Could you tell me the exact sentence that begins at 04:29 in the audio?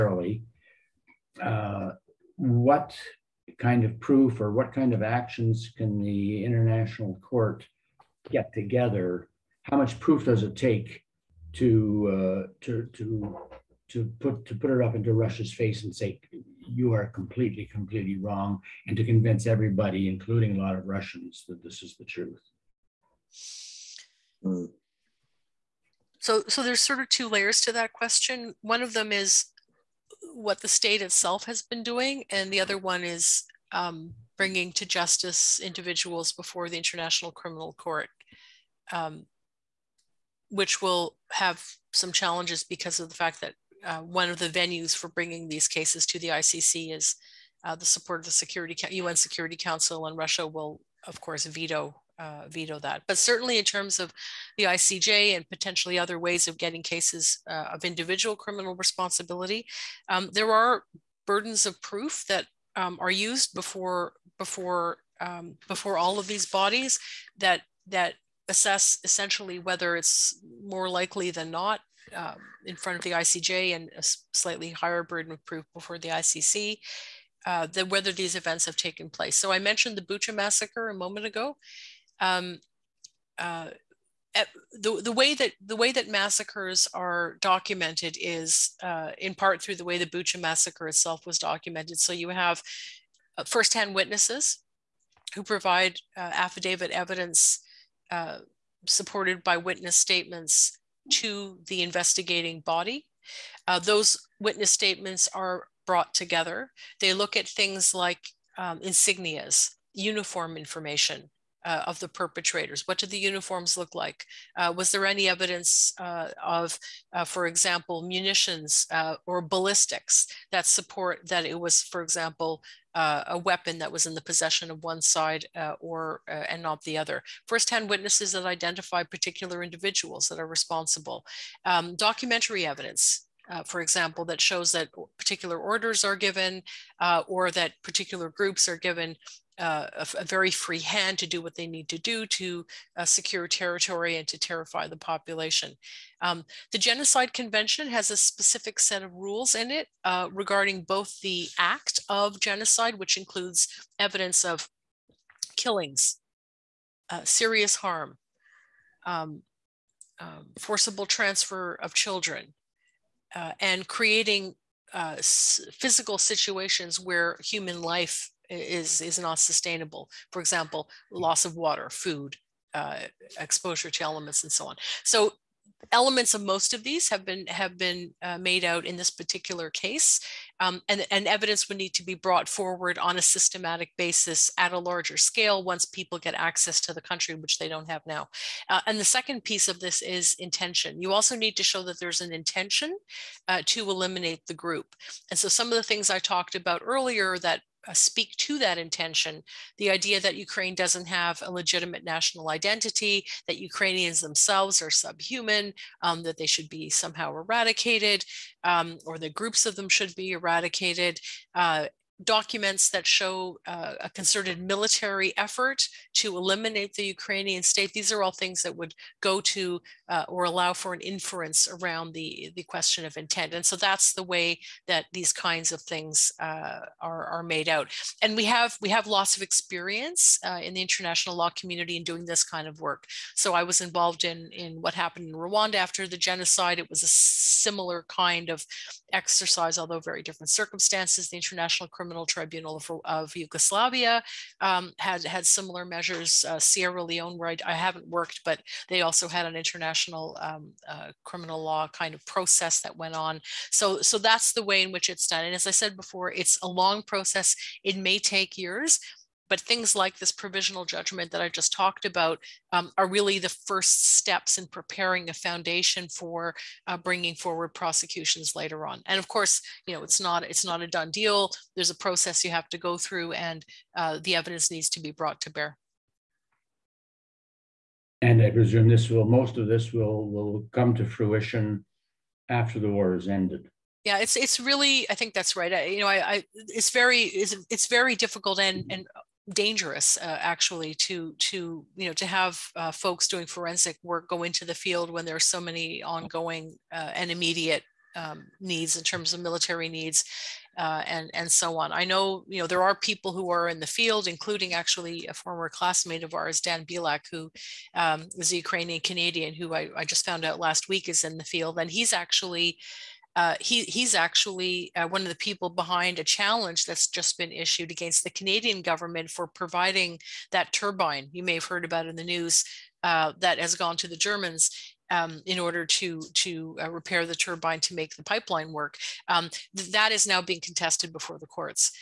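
And of course, you know, it's not it's not a done deal.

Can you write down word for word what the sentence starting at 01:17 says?
Uh, the, whether these events have taken place.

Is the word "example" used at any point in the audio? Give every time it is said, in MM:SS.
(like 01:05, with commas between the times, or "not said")
01:57, 02:02, 02:13, 02:50.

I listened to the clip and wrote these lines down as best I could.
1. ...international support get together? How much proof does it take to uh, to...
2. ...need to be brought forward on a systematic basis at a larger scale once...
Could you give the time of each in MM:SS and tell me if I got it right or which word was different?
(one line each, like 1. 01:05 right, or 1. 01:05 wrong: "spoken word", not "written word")
1. 00:06 wrong: "court", not "support"
2. 03:01 right.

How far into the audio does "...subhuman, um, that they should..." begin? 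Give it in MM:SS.
03:24.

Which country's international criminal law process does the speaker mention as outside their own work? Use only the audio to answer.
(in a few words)
Sierra Leone.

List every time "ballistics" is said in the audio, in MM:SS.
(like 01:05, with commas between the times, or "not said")
01:59.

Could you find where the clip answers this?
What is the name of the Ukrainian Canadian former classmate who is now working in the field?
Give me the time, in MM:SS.
05:06.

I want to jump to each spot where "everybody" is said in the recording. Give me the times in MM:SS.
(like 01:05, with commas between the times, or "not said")
00:19.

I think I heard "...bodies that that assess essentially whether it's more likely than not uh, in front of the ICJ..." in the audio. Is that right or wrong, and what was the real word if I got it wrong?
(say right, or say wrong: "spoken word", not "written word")
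right.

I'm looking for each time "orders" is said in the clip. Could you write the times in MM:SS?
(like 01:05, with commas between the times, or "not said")
02:15, 05:25.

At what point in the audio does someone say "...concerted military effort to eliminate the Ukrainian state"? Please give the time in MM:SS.
03:34.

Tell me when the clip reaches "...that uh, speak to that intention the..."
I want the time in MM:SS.
03:17.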